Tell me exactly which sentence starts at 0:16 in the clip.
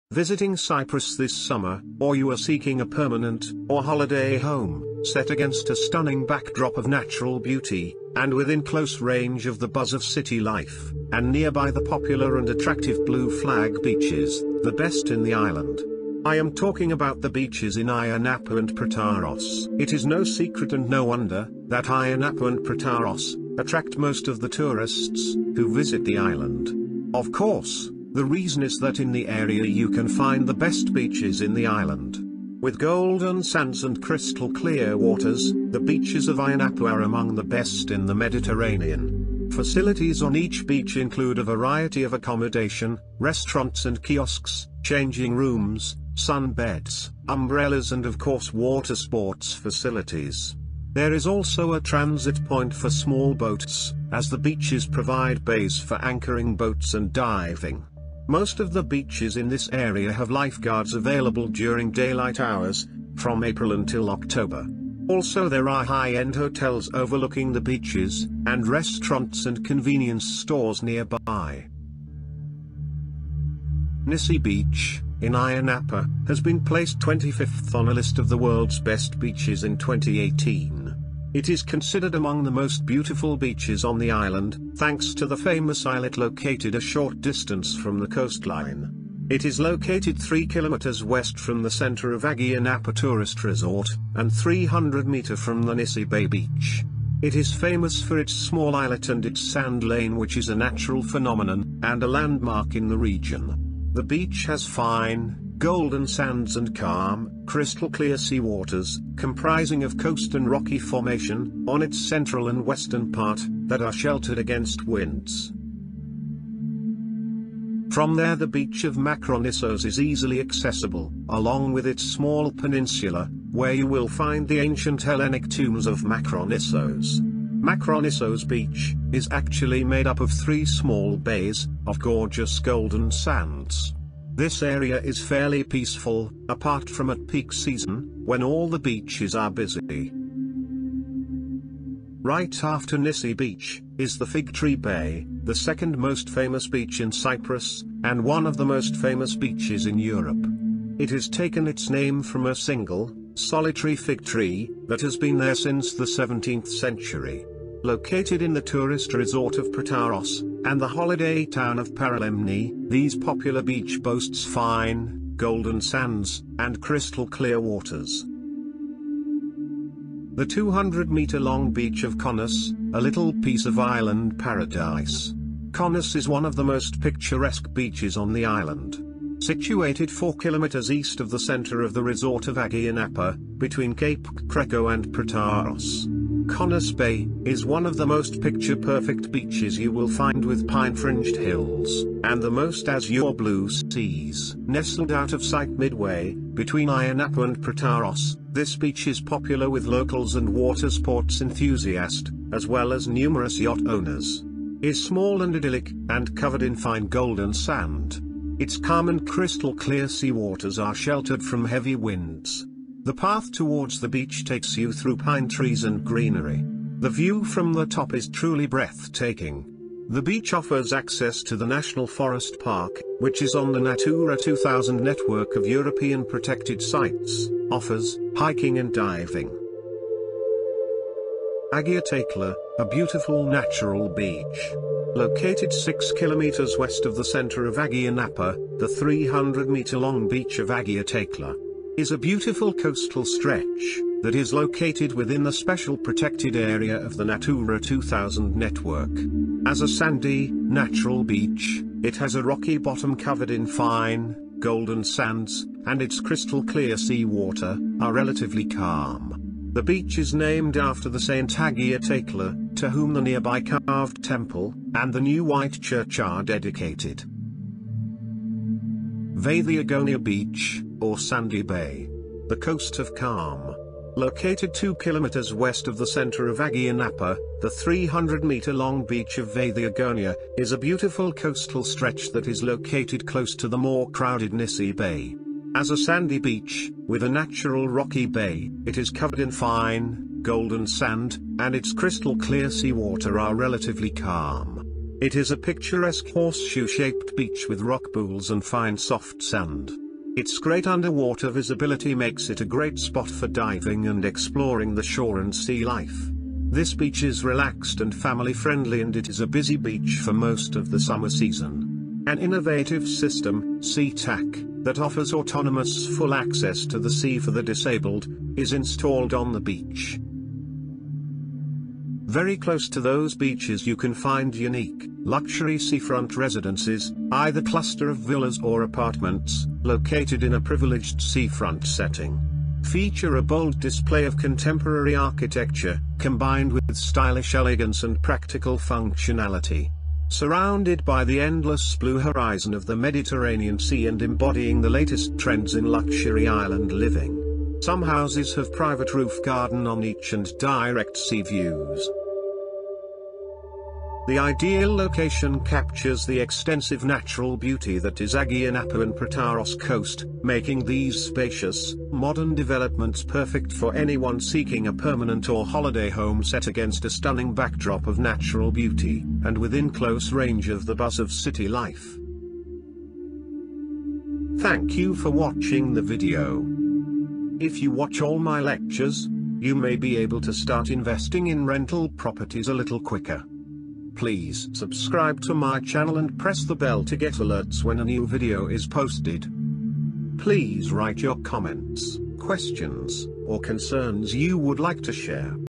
I am talking about the beaches in Ayia Napa and Protaras.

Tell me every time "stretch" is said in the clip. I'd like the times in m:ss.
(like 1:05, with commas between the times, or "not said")
4:03, 4:41.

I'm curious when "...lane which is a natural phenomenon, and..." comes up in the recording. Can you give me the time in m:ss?
1:39.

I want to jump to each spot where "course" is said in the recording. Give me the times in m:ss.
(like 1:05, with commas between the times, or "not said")
0:27, 0:48.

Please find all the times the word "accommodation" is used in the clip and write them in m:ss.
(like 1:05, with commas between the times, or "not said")
0:42.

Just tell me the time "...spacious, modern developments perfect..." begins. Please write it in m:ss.
6:01.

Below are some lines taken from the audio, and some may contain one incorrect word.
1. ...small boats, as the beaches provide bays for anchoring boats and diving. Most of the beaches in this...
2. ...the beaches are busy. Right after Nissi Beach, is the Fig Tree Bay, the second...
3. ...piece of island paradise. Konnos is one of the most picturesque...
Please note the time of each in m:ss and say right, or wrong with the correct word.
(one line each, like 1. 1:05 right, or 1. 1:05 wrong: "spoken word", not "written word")
1. 0:52 right
2. 2:18 right
3. 2:53 right.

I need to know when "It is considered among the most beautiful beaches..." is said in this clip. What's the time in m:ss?
1:21.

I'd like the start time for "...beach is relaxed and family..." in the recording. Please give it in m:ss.
5:06.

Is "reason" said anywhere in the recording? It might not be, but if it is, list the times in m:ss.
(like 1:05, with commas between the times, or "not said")
0:28.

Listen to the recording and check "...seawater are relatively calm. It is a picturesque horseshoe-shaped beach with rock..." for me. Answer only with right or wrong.
right.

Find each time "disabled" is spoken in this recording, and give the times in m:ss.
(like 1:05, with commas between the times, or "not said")
5:17.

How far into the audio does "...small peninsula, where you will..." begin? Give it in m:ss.
2:02.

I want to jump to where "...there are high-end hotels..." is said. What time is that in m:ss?
1:05.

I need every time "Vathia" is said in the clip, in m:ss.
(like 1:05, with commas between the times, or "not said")
4:29, 4:39.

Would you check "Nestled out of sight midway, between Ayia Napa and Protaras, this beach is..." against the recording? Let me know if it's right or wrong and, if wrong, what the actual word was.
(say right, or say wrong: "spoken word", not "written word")
right.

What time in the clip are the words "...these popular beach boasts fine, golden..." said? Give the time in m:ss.
2:42.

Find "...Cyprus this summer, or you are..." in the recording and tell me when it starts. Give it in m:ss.
0:00.